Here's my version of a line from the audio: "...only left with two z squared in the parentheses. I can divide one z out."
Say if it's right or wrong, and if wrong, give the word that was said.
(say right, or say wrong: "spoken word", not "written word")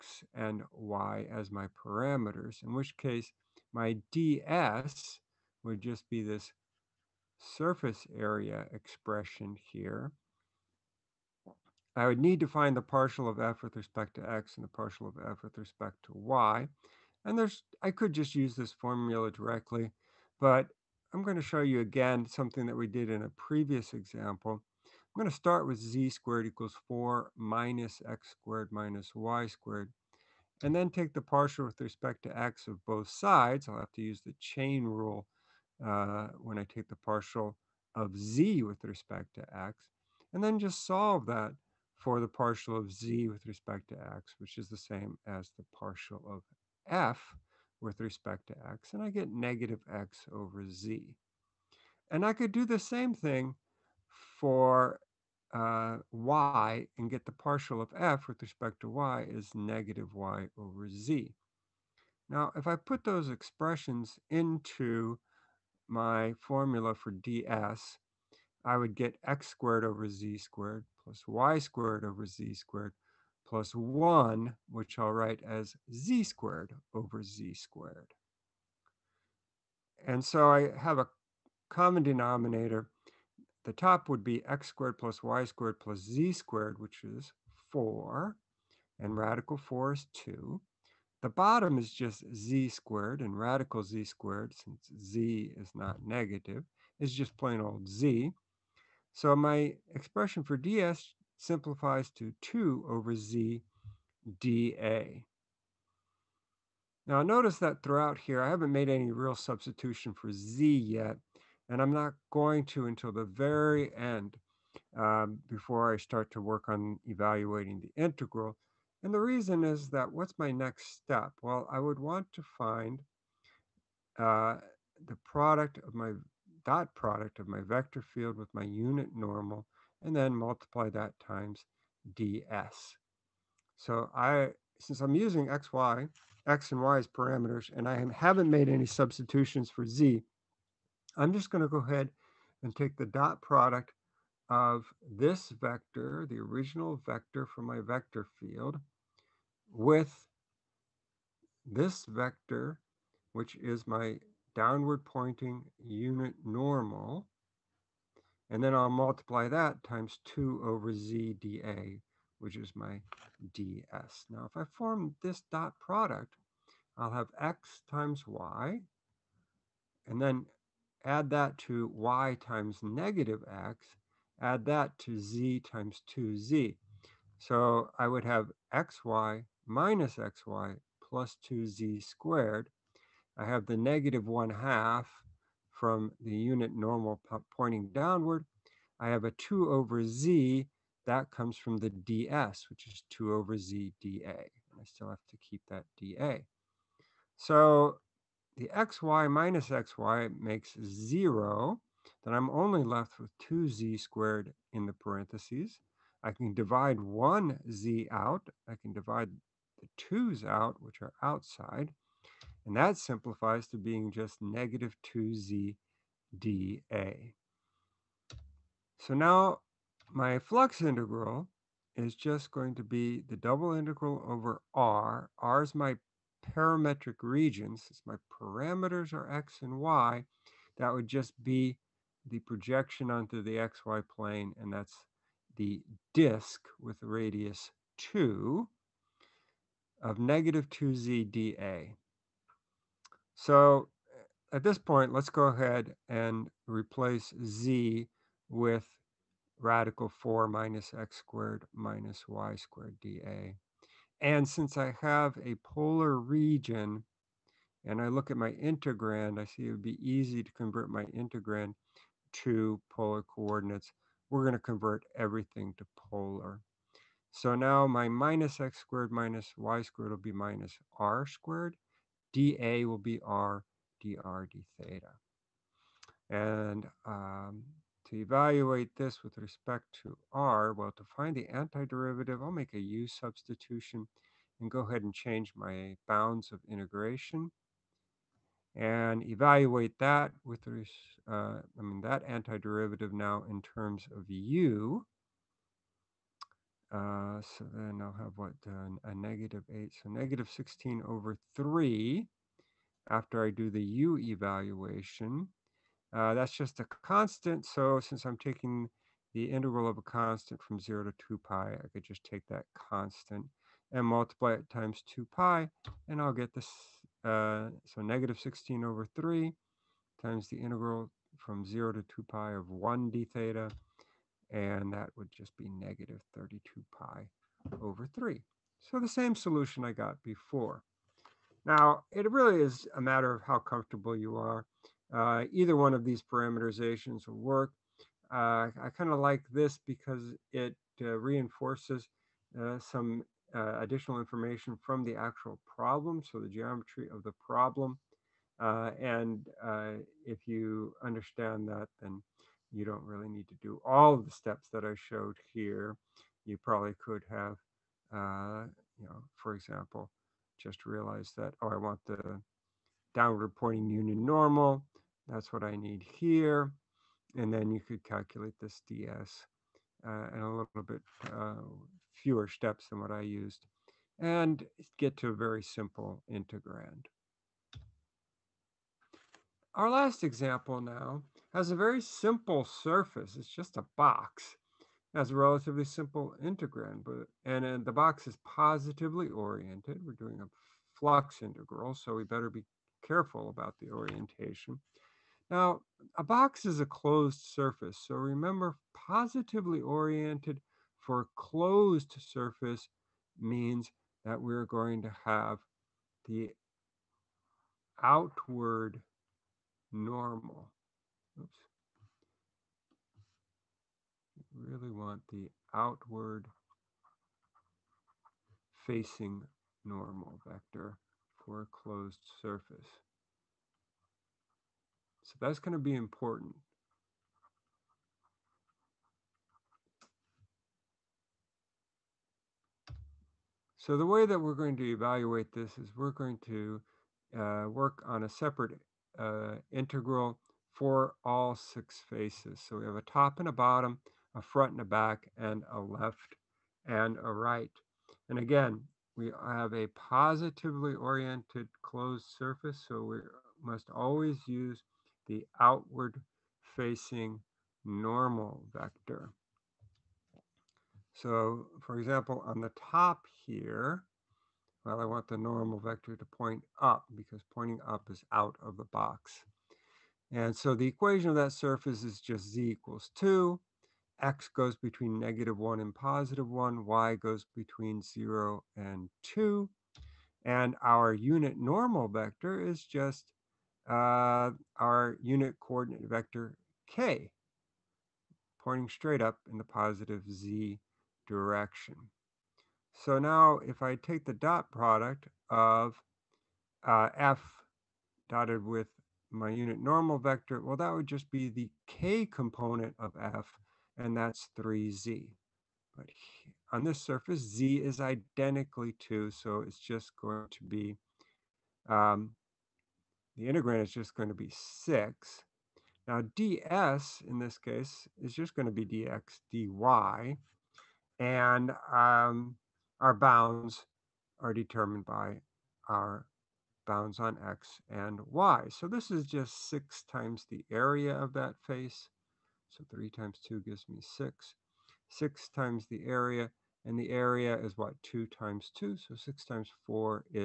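right.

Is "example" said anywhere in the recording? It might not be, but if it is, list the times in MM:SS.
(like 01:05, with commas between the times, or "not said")
00:23, 05:59, 06:20, 07:41.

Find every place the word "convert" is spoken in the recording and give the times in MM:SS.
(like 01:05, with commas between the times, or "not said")
04:20, 04:24.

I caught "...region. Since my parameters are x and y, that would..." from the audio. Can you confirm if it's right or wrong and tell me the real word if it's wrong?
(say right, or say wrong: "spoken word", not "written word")
right.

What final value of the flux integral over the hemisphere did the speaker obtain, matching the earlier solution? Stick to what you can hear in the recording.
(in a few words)
negative 32 pi over 3.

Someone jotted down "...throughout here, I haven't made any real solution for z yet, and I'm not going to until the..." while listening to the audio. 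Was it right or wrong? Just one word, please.
wrong.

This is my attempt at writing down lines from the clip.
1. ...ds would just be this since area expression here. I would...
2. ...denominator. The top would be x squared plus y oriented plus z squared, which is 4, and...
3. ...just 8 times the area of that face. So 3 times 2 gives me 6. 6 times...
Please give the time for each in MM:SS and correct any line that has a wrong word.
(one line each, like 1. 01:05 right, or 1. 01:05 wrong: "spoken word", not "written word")
1. 00:04 wrong: "surface", not "since"
2. 01:22 wrong: "squared", not "oriented"
3. 08:49 wrong: "6", not "8".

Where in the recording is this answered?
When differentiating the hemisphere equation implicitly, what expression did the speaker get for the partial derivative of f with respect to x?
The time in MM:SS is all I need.
00:49.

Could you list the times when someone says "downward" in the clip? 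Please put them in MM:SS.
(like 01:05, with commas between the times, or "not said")
02:34, 03:07, 06:03.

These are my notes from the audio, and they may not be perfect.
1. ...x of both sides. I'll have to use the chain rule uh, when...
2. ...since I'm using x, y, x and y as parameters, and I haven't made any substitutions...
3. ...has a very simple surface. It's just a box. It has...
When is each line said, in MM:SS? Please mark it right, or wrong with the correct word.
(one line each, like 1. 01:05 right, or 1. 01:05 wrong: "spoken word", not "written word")
1. 00:32 right
2. 02:14 right
3. 06:21 right.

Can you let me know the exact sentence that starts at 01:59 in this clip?
And the reason is that what's my next step?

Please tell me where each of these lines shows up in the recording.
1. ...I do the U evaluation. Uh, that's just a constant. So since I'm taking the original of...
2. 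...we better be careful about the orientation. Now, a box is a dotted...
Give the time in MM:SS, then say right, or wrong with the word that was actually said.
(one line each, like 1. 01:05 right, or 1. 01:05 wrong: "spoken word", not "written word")
1. 05:03 wrong: "integral", not "original"
2. 06:32 wrong: "closed", not "dotted".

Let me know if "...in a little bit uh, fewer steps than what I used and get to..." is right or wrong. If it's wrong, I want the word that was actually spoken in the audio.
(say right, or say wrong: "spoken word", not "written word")
right.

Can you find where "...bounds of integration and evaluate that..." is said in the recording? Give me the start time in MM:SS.
04:46.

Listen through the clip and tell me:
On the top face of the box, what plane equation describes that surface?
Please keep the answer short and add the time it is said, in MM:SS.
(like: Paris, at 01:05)
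z equals 2, at 07:52.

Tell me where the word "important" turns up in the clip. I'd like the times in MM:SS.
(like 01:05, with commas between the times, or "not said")
07:05.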